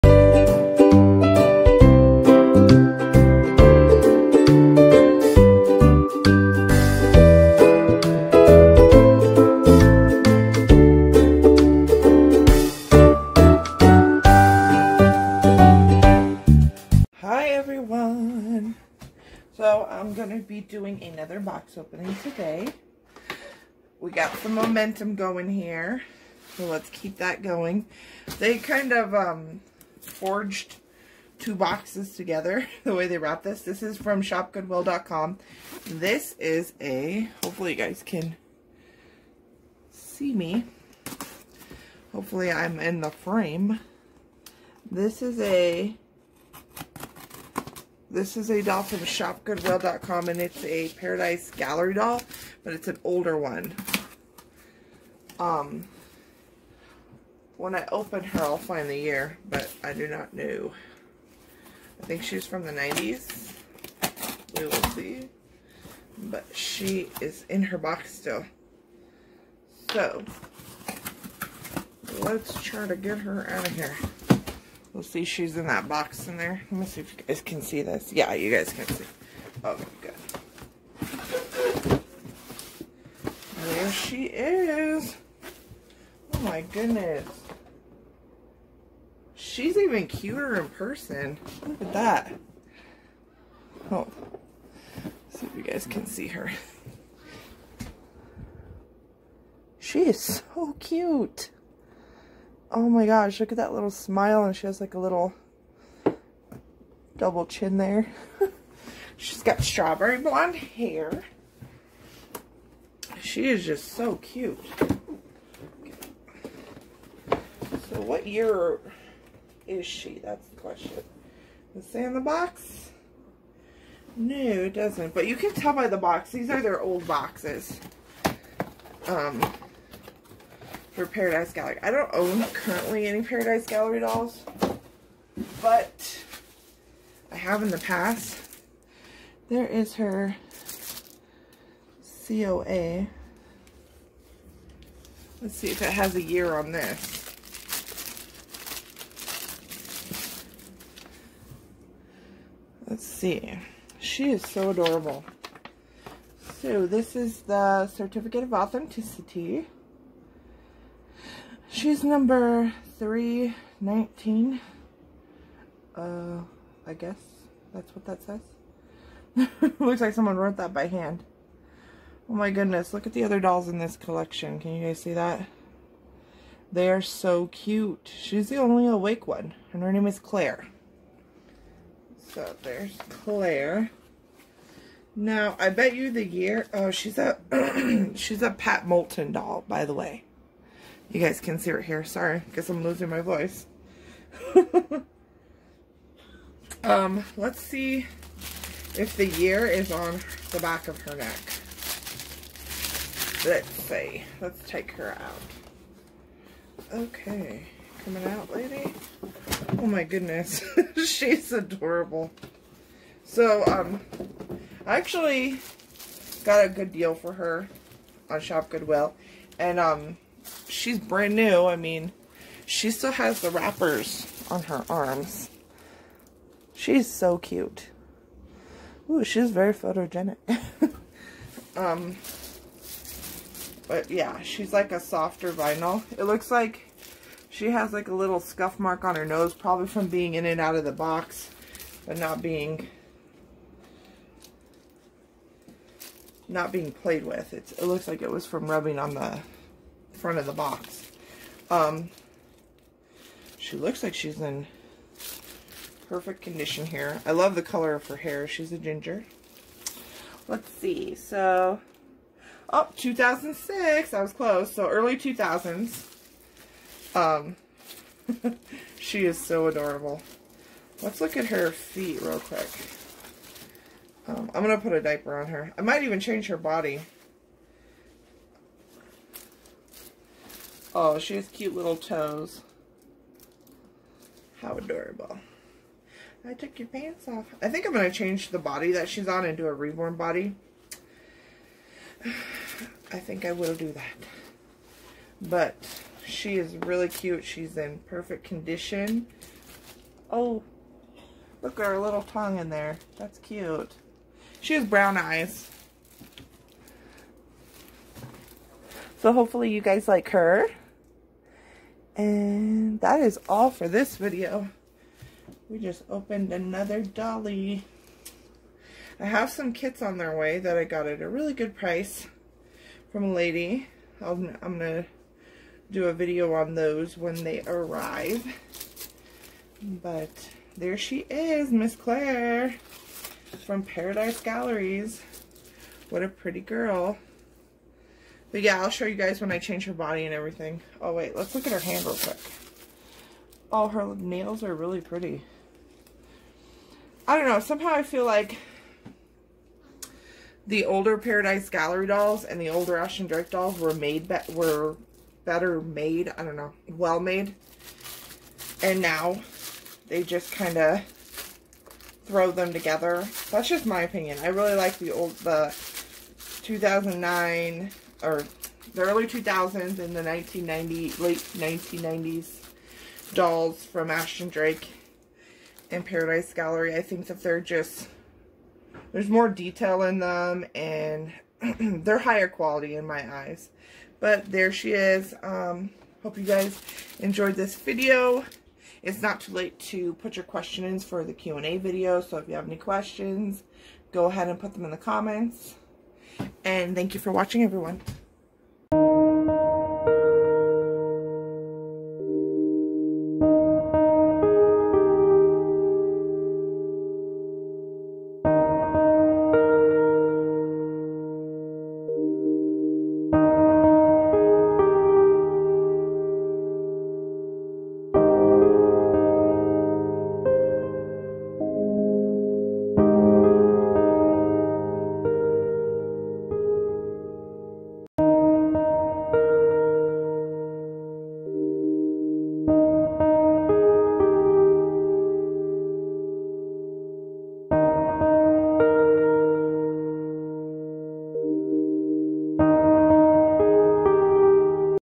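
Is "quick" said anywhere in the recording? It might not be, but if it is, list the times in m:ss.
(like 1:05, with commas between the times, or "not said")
4:32, 5:42.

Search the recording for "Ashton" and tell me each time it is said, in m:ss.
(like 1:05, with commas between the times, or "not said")
5:52, 6:14.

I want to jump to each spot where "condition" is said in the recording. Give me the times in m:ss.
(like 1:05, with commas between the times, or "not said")
4:16, 4:58.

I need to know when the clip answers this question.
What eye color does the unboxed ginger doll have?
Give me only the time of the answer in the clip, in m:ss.
5:04.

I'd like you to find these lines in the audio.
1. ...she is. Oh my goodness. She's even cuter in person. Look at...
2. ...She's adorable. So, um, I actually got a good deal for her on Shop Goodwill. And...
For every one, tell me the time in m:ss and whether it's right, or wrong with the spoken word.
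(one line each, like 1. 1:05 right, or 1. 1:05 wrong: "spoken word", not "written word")
1. 1:23 right
2. 3:31 right.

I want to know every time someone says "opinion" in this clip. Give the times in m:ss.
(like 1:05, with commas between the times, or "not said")
6:04.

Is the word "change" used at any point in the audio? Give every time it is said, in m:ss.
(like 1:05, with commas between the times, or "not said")
4:36, 4:48, 5:39.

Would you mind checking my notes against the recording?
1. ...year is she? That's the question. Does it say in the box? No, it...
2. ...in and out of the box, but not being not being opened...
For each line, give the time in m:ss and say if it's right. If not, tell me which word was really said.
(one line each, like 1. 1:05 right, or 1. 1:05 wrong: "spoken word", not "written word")
1. 1:58 right
2. 4:00 wrong: "played", not "opened".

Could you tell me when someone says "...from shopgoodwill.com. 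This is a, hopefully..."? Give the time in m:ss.
0:33.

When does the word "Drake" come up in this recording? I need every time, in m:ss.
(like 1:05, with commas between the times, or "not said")
5:53, 6:14.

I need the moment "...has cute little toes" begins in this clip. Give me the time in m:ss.
4:41.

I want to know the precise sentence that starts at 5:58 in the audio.
And now they just kind of throw them together.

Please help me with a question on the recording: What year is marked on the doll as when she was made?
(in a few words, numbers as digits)
2006.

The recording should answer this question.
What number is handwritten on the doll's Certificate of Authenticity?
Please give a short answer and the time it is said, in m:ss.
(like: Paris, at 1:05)
319, at 2:42.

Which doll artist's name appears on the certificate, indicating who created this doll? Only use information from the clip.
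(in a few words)
Pat Moulton.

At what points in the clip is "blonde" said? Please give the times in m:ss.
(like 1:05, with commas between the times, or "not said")
1:50.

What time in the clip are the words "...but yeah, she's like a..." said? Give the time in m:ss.
3:53.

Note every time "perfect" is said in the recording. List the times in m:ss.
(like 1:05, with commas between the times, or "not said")
4:16, 4:58.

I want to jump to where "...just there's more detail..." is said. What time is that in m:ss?
6:17.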